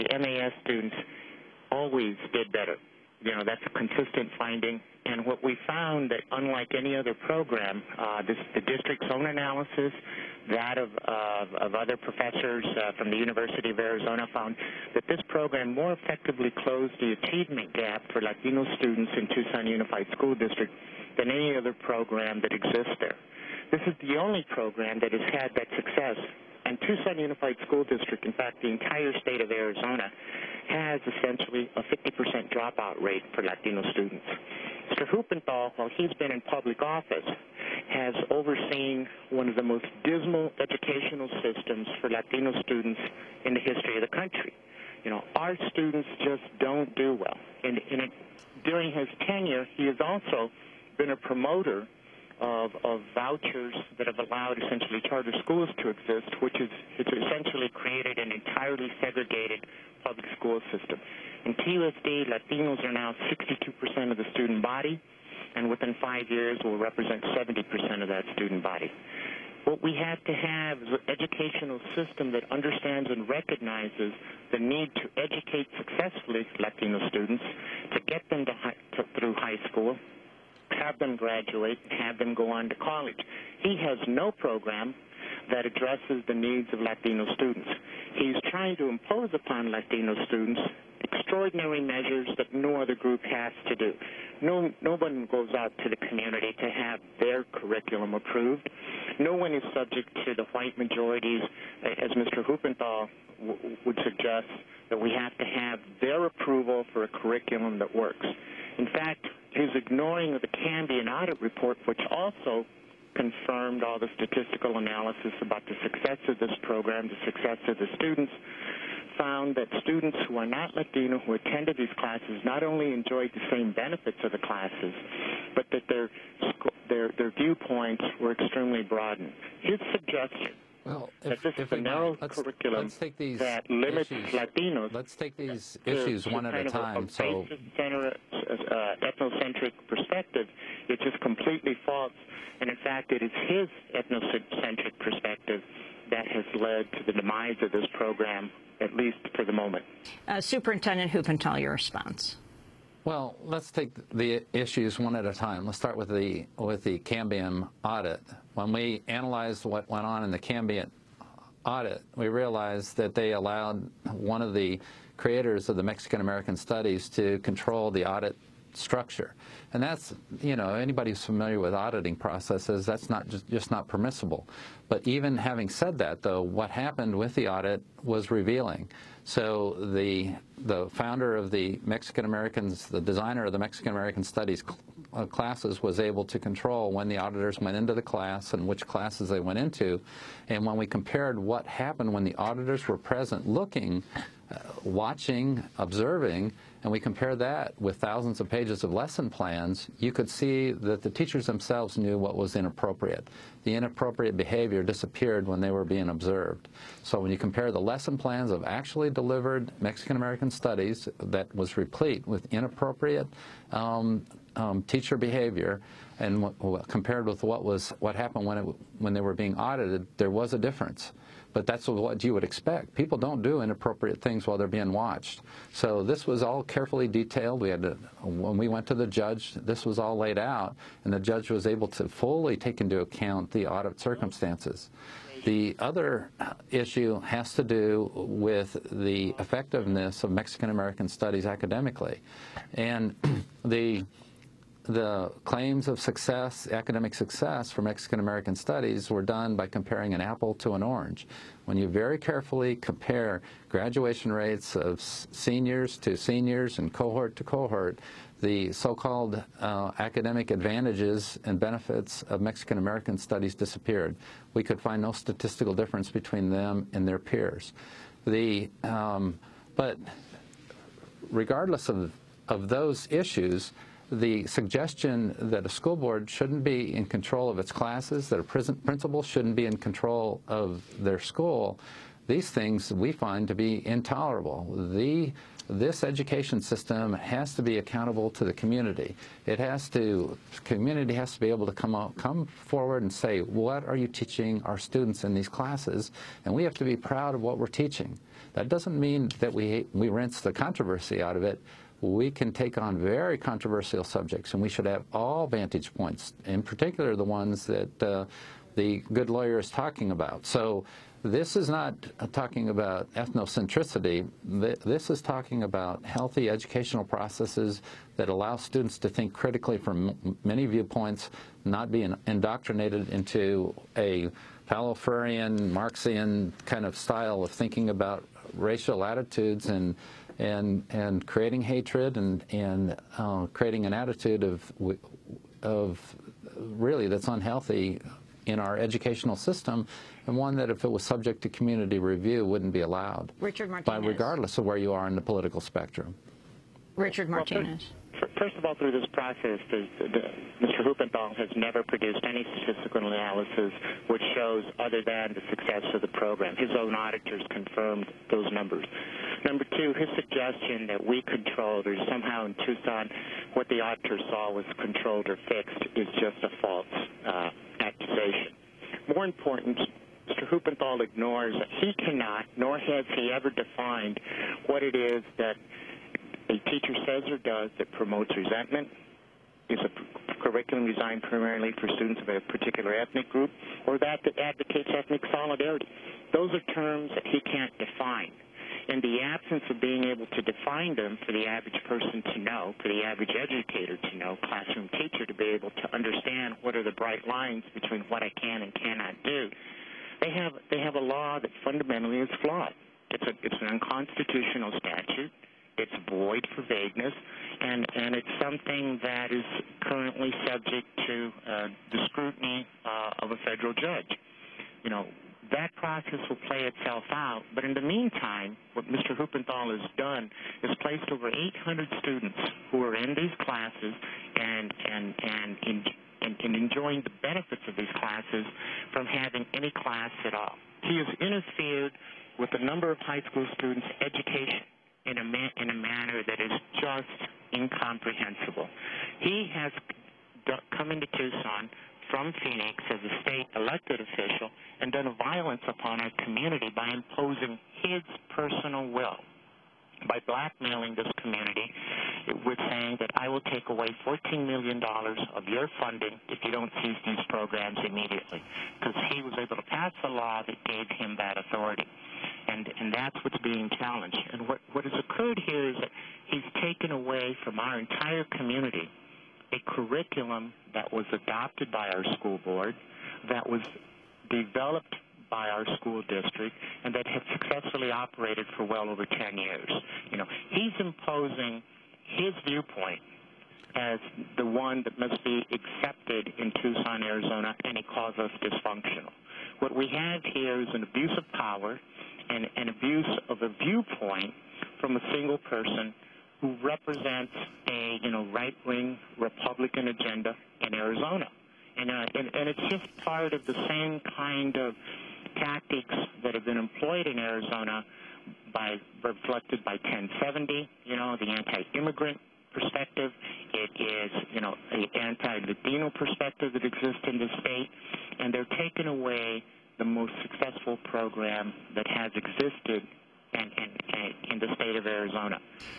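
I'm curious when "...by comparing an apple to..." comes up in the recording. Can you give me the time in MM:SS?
04:09.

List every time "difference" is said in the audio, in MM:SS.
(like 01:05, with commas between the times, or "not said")
03:40, 04:25.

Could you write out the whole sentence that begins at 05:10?
So this is not talking about ethnocentricity.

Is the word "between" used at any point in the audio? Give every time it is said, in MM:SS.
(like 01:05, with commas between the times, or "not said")
04:26, 06:37.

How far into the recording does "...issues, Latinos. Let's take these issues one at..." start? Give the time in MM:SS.
02:14.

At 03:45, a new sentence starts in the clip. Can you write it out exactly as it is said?
So this was all carefully detailed.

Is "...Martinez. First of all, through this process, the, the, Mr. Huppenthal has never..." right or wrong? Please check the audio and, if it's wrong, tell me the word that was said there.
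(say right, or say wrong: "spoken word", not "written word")
right.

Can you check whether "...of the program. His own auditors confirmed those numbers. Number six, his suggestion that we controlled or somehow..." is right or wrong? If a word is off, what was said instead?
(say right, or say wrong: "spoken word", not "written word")
wrong: "two", not "six".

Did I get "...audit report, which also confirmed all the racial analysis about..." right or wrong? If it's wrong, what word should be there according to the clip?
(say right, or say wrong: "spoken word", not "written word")
wrong: "statistical", not "racial".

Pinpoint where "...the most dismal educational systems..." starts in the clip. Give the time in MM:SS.
00:39.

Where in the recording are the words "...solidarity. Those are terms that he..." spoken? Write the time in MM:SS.
06:25.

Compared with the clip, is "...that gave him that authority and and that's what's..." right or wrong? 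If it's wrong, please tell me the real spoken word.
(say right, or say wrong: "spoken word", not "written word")
right.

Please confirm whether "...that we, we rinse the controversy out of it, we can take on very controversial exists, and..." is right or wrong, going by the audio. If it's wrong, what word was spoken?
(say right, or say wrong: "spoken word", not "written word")
wrong: "subjects", not "exists".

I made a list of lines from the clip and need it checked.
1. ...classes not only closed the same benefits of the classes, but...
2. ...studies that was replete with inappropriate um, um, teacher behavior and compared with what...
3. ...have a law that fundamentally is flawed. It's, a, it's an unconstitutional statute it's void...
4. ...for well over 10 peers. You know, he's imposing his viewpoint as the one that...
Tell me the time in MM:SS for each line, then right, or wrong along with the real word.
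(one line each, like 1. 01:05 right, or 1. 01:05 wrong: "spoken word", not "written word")
1. 02:01 wrong: "enjoyed", not "closed"
2. 03:30 right
3. 06:40 right
4. 07:58 wrong: "years", not "peers".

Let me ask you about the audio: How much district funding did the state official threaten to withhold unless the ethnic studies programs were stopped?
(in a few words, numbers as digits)
$14 million.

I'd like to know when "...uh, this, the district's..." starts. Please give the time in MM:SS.
00:07.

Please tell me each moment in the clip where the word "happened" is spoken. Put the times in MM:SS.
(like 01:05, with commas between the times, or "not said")
02:56, 03:11, 03:38.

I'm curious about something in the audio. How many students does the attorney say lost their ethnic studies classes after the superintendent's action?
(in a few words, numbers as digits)
800.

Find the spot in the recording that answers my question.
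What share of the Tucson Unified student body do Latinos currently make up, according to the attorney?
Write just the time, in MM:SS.
01:03.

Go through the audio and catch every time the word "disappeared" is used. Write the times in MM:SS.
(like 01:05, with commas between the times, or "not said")
03:24, 04:23.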